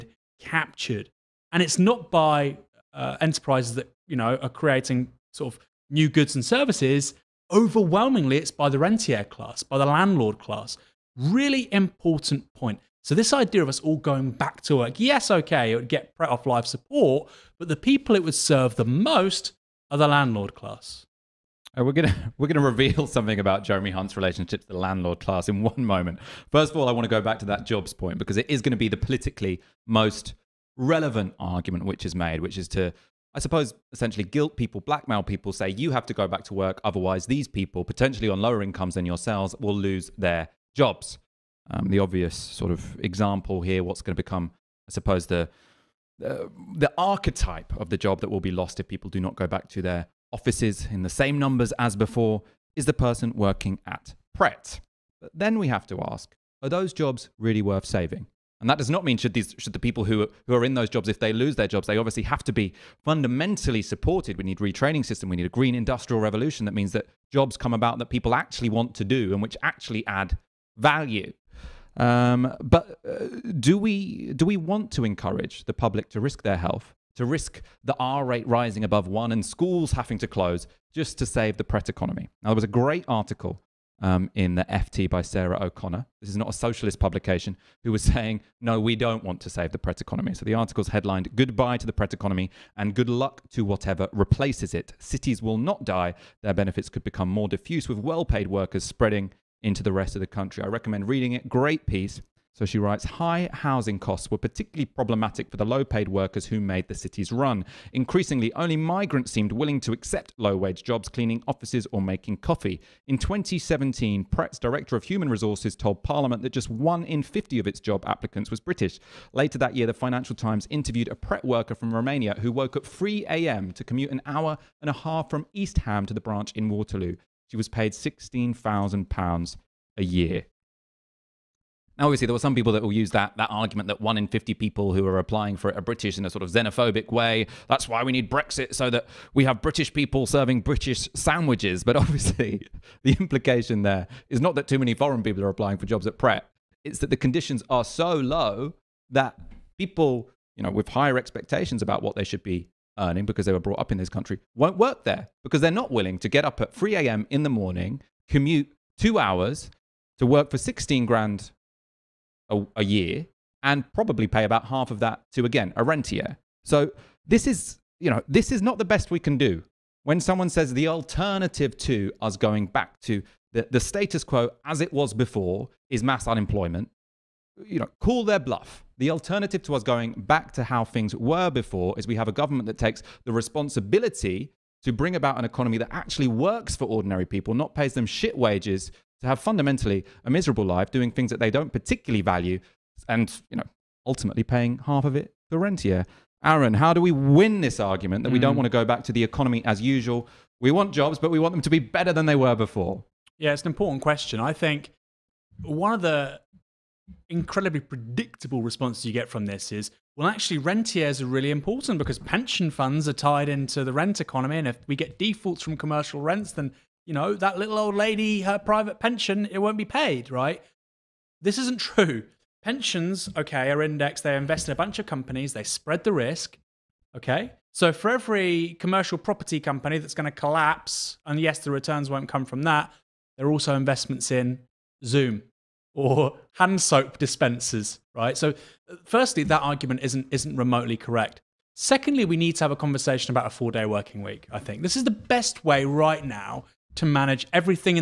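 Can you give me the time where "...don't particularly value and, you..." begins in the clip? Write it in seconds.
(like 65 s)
191 s.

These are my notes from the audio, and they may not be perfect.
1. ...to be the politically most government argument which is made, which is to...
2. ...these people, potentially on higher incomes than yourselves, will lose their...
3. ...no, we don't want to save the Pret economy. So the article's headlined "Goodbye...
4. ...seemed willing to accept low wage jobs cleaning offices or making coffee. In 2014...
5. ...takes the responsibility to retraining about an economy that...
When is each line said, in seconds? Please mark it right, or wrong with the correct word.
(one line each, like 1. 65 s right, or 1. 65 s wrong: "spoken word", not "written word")
1. 28 s wrong: "relevant", not "government"
2. 37 s wrong: "lower", not "higher"
3. 88 s right
4. 109 s wrong: "2017", not "2014"
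5. 182 s wrong: "bring", not "retraining".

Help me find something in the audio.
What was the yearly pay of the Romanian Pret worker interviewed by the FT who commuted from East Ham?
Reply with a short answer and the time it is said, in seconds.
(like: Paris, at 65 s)
£16,000, at 127 s.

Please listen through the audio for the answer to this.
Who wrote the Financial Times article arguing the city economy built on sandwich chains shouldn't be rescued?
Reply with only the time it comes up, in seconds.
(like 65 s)
85 s.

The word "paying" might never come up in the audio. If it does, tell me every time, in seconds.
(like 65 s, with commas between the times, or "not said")
194 s.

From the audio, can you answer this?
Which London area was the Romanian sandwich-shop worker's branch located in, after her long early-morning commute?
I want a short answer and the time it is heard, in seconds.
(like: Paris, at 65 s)
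Waterloo, at 126 s.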